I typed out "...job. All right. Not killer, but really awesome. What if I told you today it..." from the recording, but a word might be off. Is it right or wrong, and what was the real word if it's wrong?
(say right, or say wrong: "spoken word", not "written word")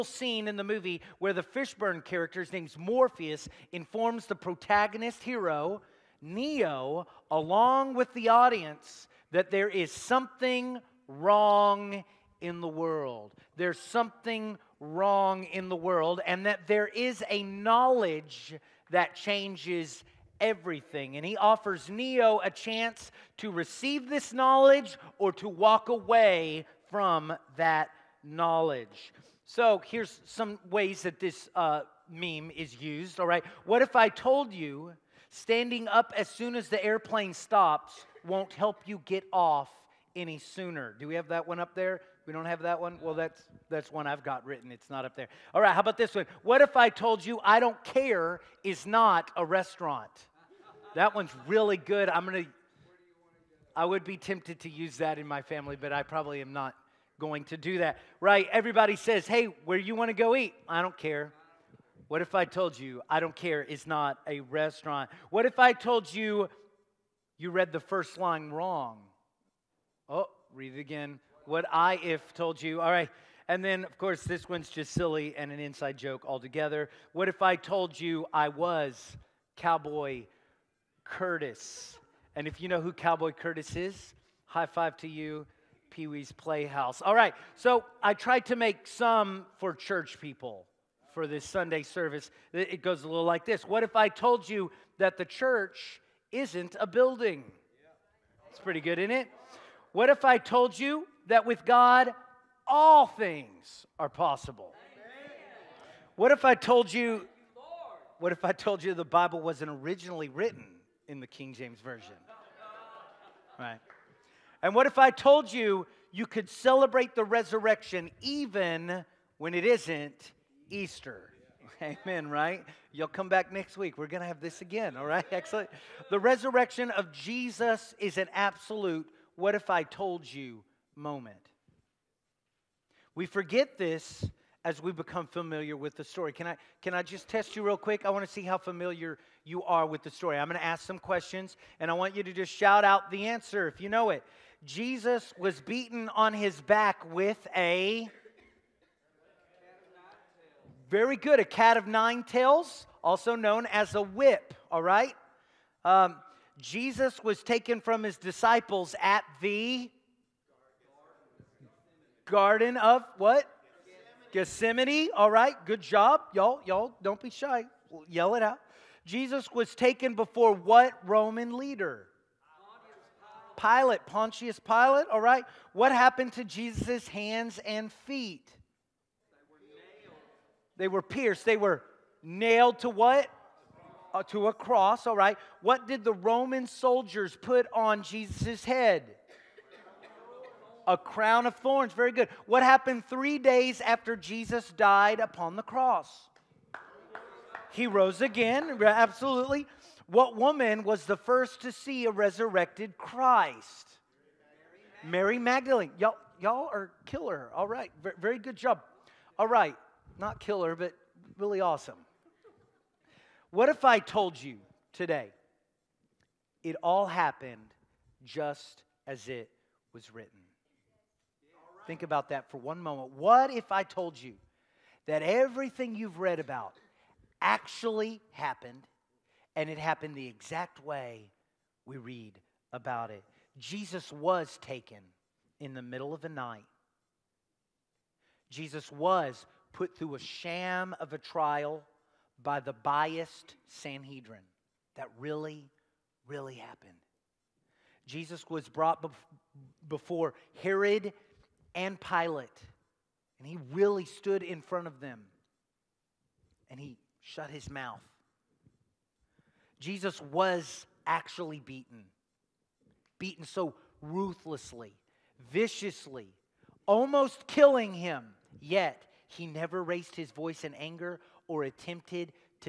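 right.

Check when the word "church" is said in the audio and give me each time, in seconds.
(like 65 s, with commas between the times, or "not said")
89 s, 95 s.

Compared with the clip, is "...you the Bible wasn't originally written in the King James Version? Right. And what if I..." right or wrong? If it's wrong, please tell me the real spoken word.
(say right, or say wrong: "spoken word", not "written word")
right.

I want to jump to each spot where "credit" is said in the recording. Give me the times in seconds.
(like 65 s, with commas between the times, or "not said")
not said.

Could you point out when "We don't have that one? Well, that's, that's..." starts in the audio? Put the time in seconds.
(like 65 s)
42 s.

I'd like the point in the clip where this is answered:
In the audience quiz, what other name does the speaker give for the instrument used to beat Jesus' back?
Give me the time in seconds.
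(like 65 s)
151 s.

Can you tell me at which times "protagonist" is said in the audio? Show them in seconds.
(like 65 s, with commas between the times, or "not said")
4 s.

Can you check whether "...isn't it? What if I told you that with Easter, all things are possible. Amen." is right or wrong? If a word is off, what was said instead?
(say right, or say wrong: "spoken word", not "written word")
wrong: "God", not "Easter".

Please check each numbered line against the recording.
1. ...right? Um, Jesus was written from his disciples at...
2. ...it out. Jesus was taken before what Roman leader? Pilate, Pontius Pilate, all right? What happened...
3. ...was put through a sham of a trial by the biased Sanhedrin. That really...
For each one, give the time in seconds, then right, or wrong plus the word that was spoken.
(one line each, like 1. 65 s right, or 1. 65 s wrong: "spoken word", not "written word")
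1. 154 s wrong: "taken", not "written"
2. 168 s right
3. 238 s right.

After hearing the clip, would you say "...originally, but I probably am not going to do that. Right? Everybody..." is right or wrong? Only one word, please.
wrong.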